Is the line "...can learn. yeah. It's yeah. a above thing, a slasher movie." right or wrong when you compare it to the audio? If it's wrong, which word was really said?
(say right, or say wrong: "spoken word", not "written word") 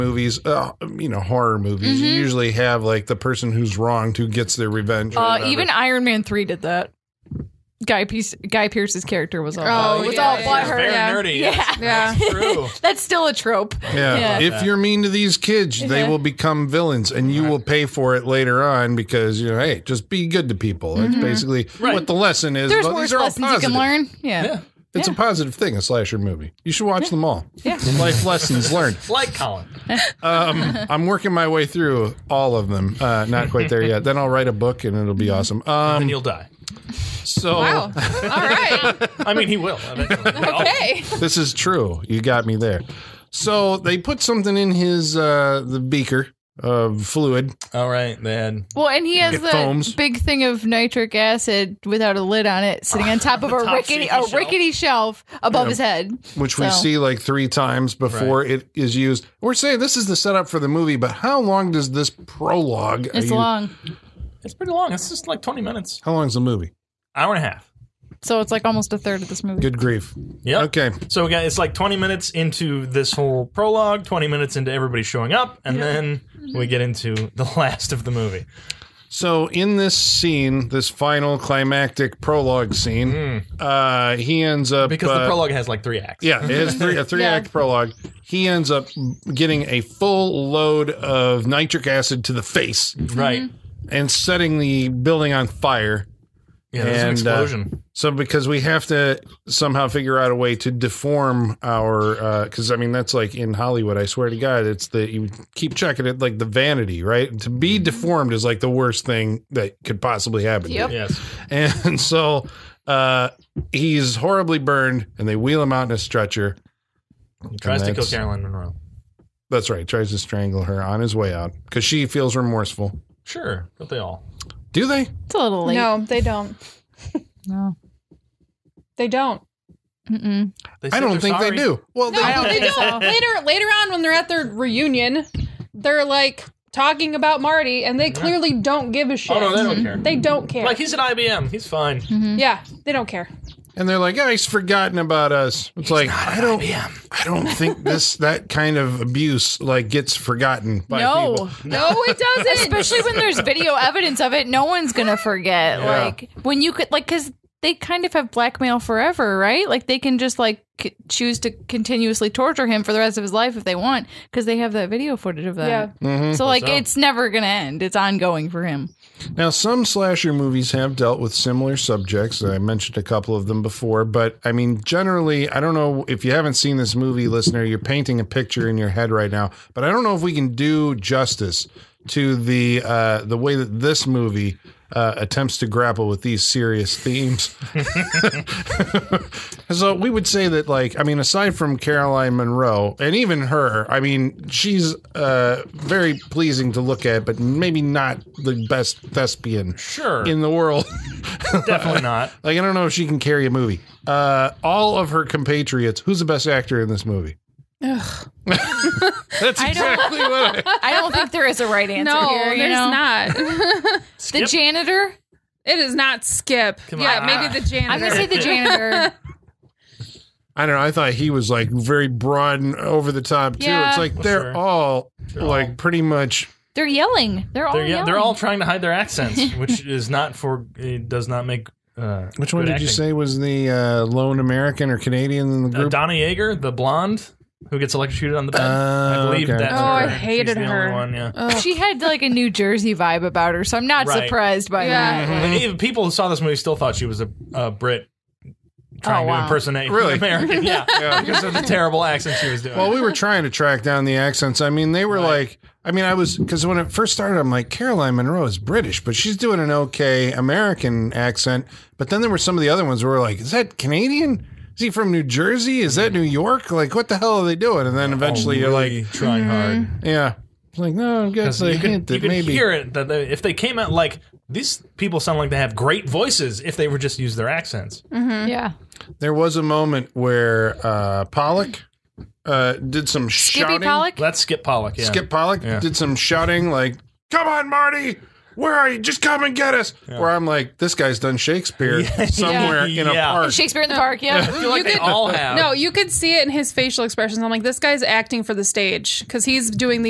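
wrong: "positive", not "above".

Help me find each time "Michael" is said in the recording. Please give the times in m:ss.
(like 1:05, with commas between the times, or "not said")
not said.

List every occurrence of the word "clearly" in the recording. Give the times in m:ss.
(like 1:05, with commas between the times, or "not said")
2:18.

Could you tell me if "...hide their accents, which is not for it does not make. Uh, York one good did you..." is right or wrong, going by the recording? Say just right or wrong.
wrong.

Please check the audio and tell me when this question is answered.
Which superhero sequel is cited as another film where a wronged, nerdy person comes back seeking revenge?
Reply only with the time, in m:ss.
0:05.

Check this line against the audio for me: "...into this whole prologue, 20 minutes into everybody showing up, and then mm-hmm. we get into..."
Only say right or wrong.
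right.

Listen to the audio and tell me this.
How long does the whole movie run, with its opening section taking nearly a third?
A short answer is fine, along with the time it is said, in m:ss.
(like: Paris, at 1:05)
hour and a half, at 1:07.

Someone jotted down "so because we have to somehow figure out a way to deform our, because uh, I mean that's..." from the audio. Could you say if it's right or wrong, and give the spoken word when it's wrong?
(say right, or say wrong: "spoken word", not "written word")
right.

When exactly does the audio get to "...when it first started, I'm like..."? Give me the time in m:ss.
4:16.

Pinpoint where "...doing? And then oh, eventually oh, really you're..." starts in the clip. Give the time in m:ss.
4:27.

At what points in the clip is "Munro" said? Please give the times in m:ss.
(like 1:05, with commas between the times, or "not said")
1:58, 3:12, 4:18.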